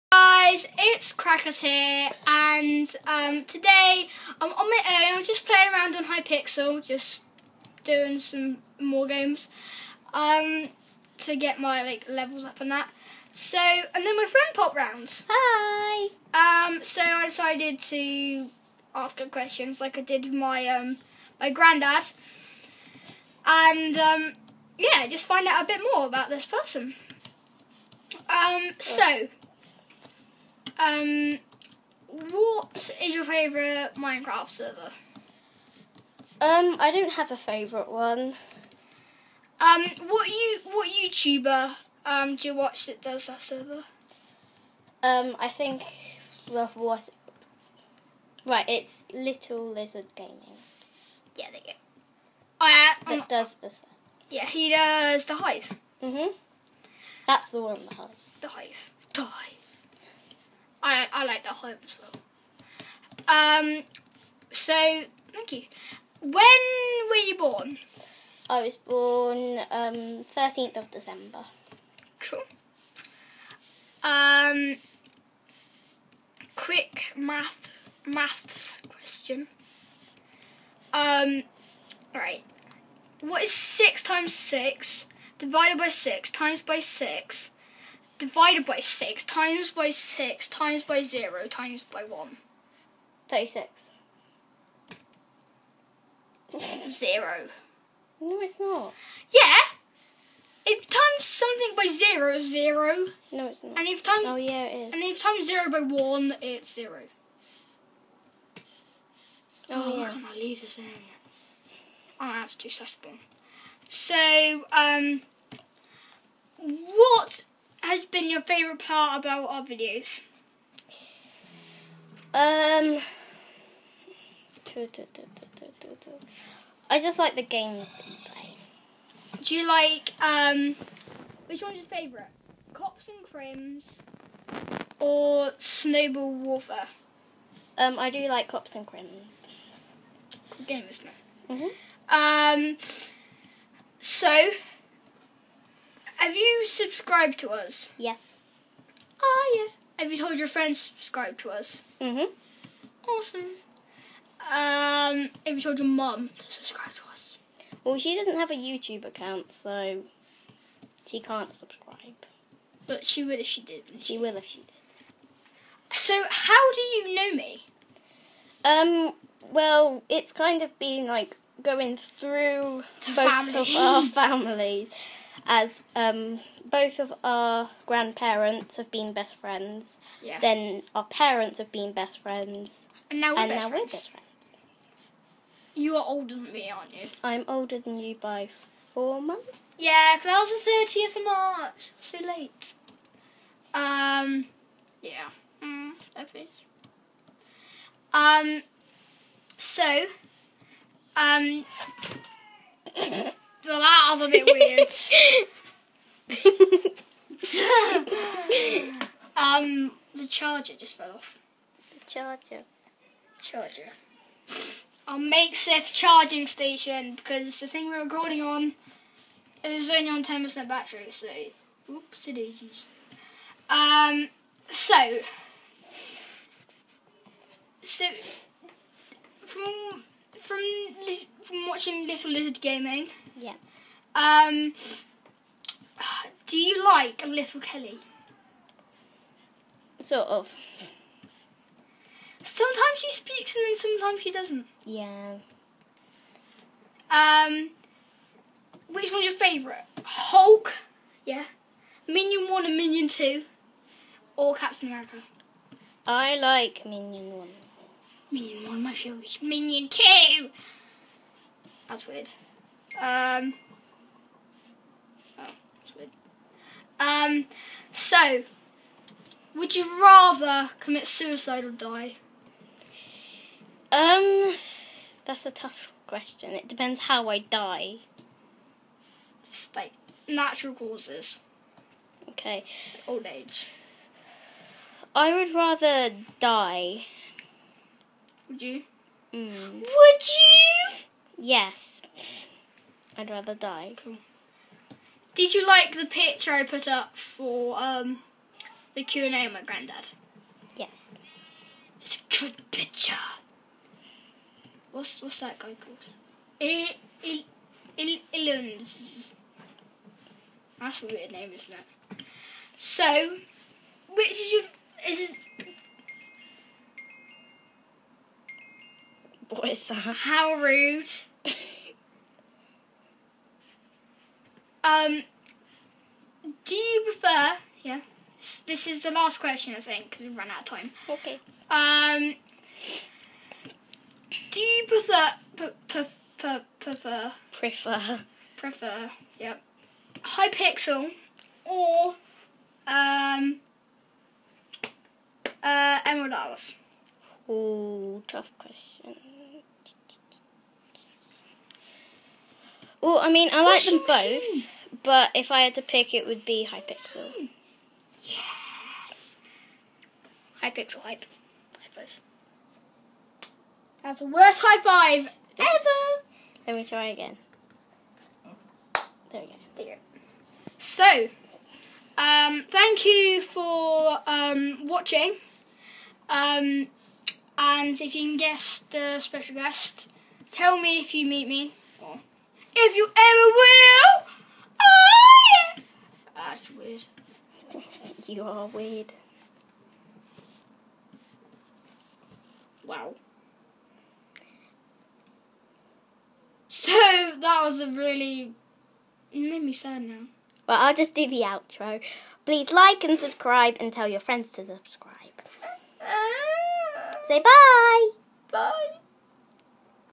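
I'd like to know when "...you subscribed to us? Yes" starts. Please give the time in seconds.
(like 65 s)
146 s.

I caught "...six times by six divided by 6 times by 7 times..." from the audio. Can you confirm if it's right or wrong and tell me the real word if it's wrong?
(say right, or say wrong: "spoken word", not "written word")
wrong: "6", not "7".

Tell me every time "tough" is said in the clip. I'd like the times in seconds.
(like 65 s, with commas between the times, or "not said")
275 s, 348 s.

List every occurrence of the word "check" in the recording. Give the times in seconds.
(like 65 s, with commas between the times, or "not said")
not said.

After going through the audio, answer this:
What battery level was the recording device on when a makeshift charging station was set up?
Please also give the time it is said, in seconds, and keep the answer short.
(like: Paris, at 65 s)
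10%, at 220 s.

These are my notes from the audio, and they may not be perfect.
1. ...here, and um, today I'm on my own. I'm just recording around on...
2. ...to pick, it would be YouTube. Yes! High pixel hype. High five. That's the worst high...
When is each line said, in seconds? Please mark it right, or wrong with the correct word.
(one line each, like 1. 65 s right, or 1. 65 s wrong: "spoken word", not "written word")
1. 1 s wrong: "playing", not "recording"
2. 355 s wrong: "Hypixel", not "YouTube".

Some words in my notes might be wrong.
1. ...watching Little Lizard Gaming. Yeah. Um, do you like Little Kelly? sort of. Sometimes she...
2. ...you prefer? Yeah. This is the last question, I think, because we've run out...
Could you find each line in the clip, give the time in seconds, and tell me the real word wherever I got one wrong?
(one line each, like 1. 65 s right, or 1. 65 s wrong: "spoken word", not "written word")
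1. 231 s right
2. 326 s right.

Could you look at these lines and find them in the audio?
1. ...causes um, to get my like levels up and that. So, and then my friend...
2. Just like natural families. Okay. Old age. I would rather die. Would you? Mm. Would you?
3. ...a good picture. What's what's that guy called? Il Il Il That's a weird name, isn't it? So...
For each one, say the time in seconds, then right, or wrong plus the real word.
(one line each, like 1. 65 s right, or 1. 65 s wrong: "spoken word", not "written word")
1. 9 s wrong: "games", not "causes"
2. 279 s wrong: "causes", not "families"
3. 302 s right.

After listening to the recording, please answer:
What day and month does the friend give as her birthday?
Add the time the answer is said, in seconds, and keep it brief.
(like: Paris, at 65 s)
13th of December, at 70 s.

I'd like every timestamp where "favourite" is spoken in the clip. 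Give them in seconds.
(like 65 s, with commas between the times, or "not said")
33 s, 37 s, 118 s, 131 s, 249 s, 258 s.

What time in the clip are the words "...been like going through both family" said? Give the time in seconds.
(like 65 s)
170 s.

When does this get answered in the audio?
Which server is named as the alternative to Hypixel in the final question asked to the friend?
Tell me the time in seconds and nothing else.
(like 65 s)
346 s.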